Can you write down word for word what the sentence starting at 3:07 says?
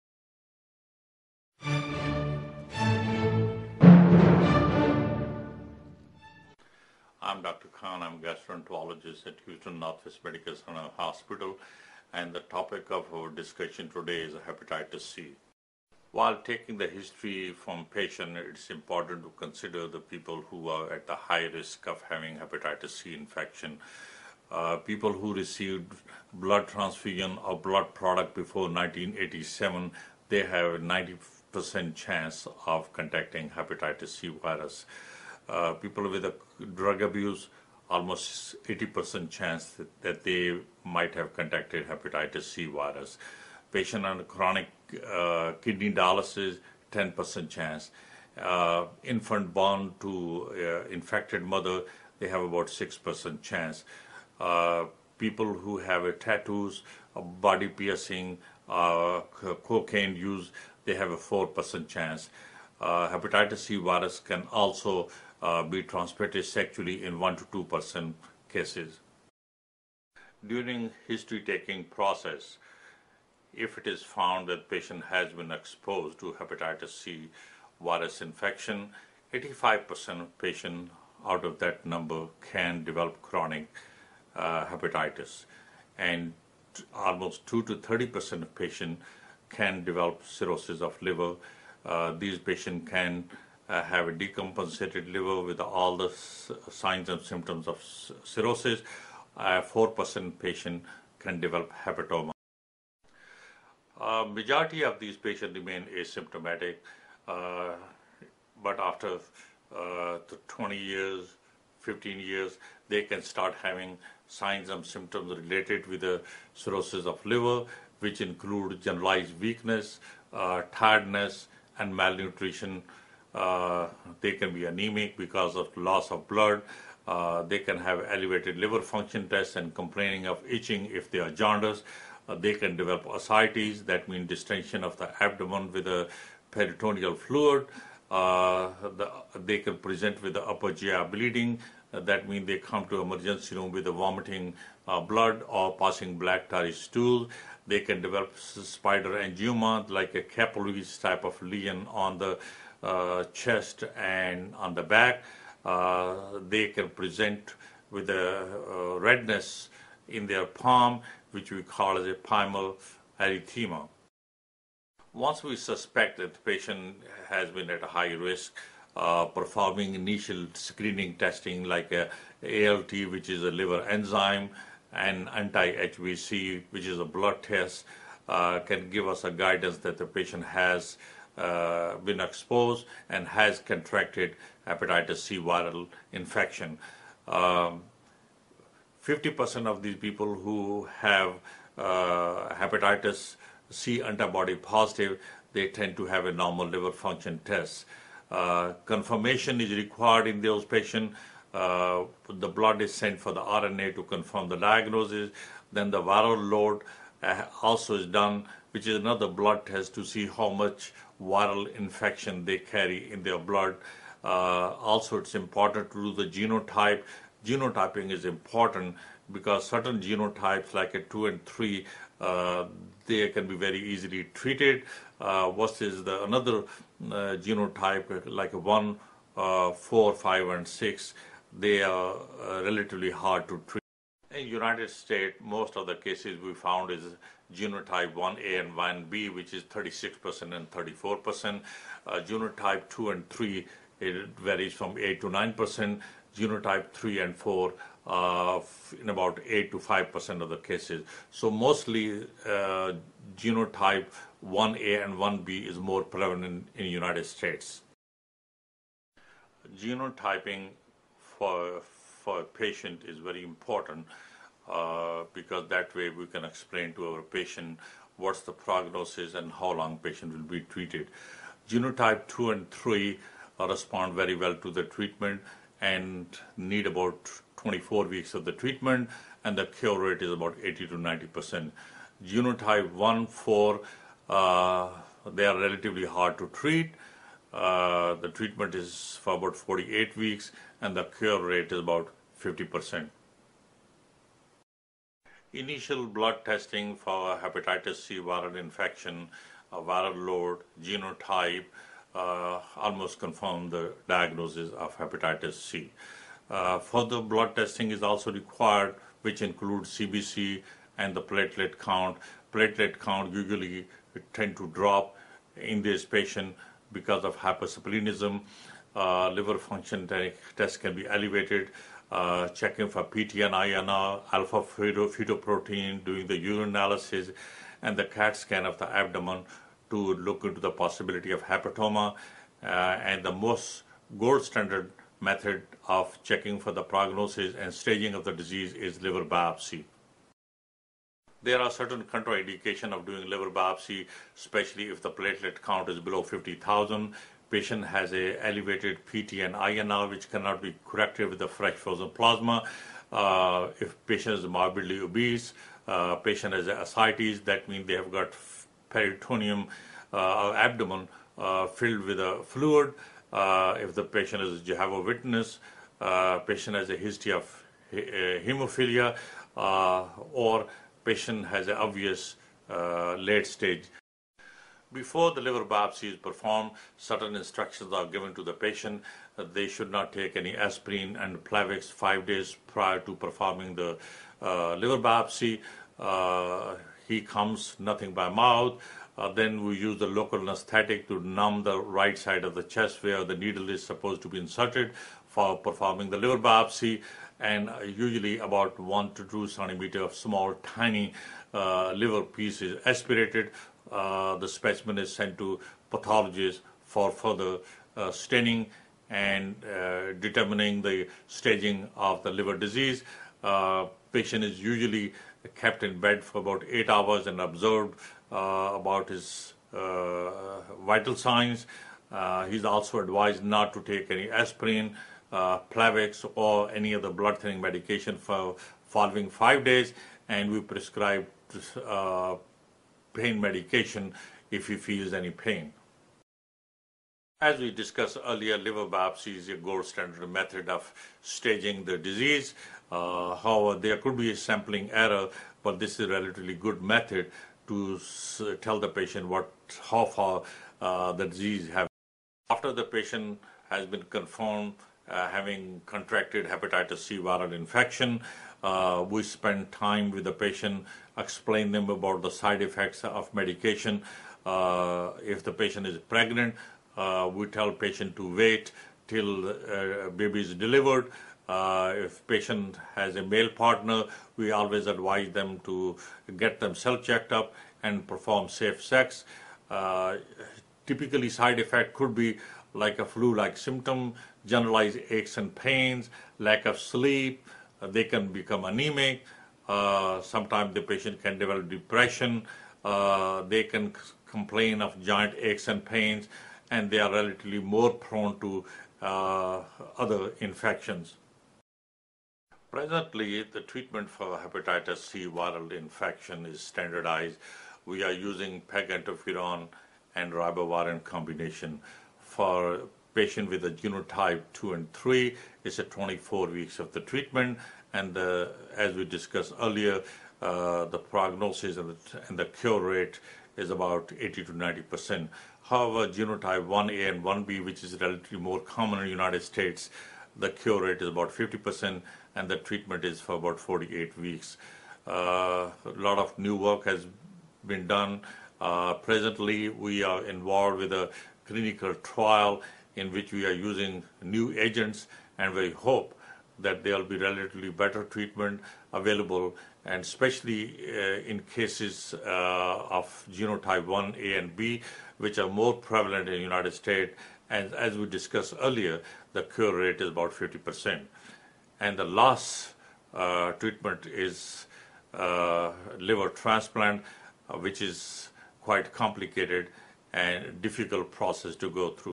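50% um, of these people who have uh, hepatitis C antibody positive, they tend to have a normal liver function test.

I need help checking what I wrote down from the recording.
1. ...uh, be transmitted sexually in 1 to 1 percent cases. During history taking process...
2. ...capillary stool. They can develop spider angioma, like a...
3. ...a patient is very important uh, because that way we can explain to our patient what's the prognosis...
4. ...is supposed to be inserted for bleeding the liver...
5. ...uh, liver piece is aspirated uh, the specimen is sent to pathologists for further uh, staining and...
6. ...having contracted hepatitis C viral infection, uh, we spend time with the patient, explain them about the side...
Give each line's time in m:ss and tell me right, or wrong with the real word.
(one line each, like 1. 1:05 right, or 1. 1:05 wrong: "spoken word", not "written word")
1. 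1:05 wrong: "2", not "1"
2. 2:26 wrong: "tarry", not "capillary"
3. 4:22 right
4. 6:33 wrong: "performing", not "bleeding"
5. 6:41 right
6. 7:35 right.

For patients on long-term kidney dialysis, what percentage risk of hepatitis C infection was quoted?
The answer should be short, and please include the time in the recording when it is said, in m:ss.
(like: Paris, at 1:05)
10%, at 0:46.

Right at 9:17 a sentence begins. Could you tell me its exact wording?
And as we discussed earlier, the cure rate is about 50%.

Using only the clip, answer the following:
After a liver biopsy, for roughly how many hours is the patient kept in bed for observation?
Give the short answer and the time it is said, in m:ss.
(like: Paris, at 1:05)
8 hours, at 6:56.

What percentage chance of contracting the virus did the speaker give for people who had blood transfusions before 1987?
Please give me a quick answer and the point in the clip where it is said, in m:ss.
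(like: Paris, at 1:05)
90%, at 0:30.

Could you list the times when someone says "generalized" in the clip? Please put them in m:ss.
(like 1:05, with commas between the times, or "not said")
1:58, 8:04.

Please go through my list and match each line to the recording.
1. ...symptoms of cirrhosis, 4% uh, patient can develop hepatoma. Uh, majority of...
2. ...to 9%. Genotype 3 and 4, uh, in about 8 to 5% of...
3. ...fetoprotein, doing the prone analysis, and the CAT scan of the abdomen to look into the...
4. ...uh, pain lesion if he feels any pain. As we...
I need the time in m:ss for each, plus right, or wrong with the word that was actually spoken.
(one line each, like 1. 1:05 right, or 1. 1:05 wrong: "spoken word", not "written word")
1. 1:37 right
2. 4:05 right
3. 5:24 wrong: "urine", not "prone"
4. 7:11 wrong: "medication", not "lesion".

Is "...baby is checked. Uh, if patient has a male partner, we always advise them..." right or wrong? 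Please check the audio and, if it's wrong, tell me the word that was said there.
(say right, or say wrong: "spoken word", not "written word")
wrong: "delivered", not "checked".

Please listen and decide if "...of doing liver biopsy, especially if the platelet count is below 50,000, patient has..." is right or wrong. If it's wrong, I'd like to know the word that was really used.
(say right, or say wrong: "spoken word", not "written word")
right.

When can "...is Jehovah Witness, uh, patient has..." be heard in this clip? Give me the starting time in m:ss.
6:04.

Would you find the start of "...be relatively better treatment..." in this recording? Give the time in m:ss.
9:07.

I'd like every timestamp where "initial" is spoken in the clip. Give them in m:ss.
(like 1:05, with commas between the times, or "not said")
2:49, 4:55.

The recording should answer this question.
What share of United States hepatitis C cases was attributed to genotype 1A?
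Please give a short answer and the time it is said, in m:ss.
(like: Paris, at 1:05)
36%, at 3:59.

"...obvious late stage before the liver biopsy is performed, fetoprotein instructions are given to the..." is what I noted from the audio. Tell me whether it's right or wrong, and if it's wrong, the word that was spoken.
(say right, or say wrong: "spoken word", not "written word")
wrong: "certain", not "fetoprotein".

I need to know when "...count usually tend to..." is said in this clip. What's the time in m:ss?
5:12.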